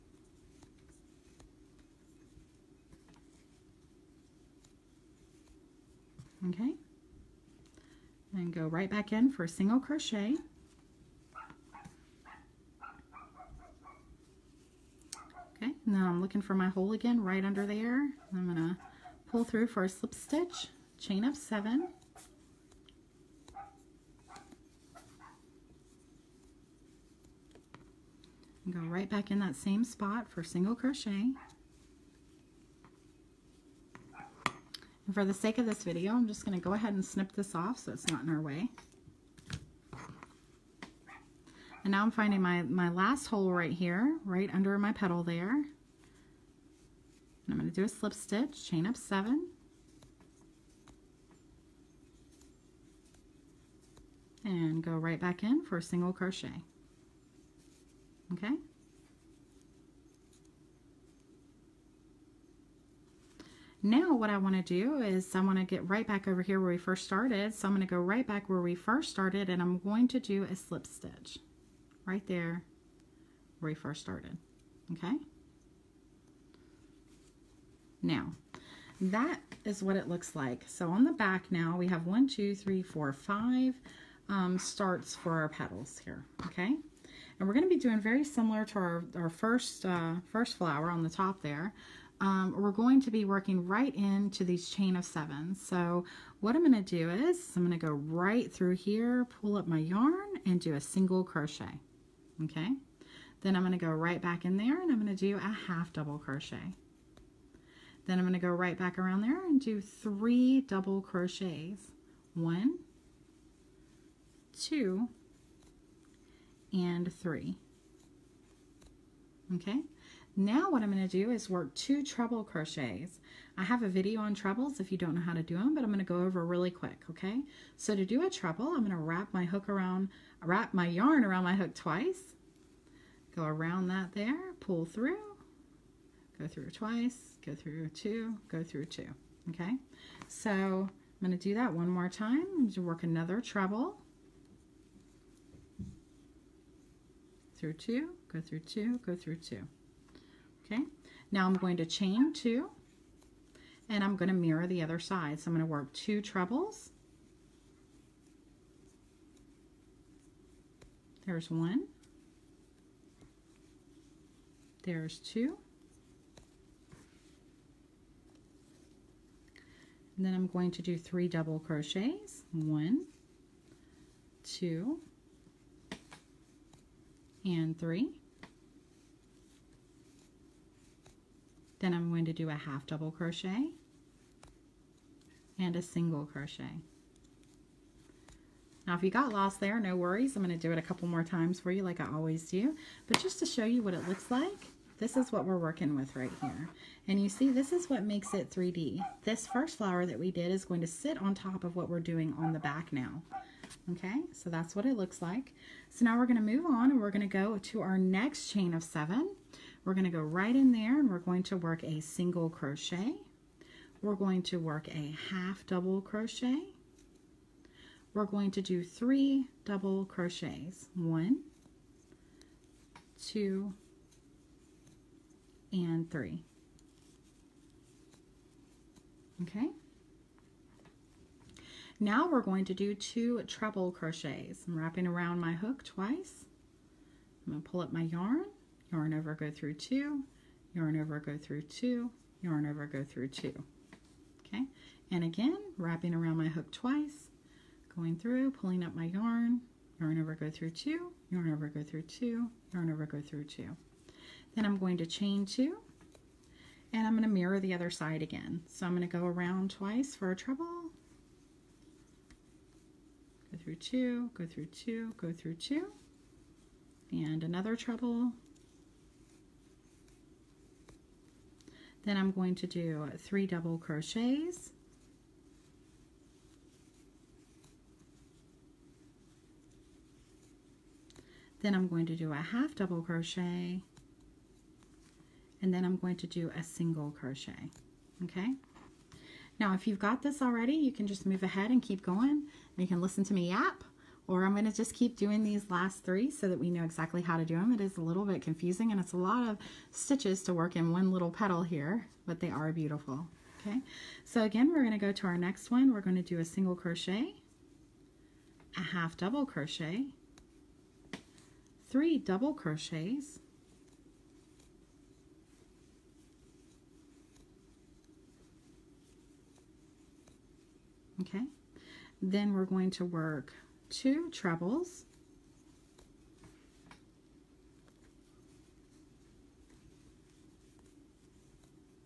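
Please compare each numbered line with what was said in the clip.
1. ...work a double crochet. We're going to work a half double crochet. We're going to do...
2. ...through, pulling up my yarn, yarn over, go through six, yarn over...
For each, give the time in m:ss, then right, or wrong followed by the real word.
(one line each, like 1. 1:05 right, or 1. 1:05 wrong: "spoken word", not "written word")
1. 3:31 wrong: "single", not "double"
2. 4:08 wrong: "two", not "six".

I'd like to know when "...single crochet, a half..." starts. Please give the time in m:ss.
5:06.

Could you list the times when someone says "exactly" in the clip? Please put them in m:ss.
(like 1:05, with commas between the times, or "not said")
4:56.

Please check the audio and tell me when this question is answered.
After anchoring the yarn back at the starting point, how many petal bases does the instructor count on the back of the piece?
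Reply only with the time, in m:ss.
1:23.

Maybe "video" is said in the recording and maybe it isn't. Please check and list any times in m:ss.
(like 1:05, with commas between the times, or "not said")
0:35, 2:03.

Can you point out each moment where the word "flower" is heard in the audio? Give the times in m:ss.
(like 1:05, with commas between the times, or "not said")
1:30, 3:19.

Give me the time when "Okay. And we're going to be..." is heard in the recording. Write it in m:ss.
1:26.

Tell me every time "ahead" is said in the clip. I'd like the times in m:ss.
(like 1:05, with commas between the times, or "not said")
0:36, 4:51.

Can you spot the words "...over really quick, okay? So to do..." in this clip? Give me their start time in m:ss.
2:06.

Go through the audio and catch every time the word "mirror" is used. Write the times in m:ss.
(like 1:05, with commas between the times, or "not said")
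2:34, 4:17.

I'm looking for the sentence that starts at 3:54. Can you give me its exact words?
I'm wrapping around my hook twice.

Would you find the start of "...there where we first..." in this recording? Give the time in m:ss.
1:12.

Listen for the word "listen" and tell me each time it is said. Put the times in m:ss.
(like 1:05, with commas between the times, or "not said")
4:53.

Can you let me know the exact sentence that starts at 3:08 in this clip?
Now if you got lost there, no worries.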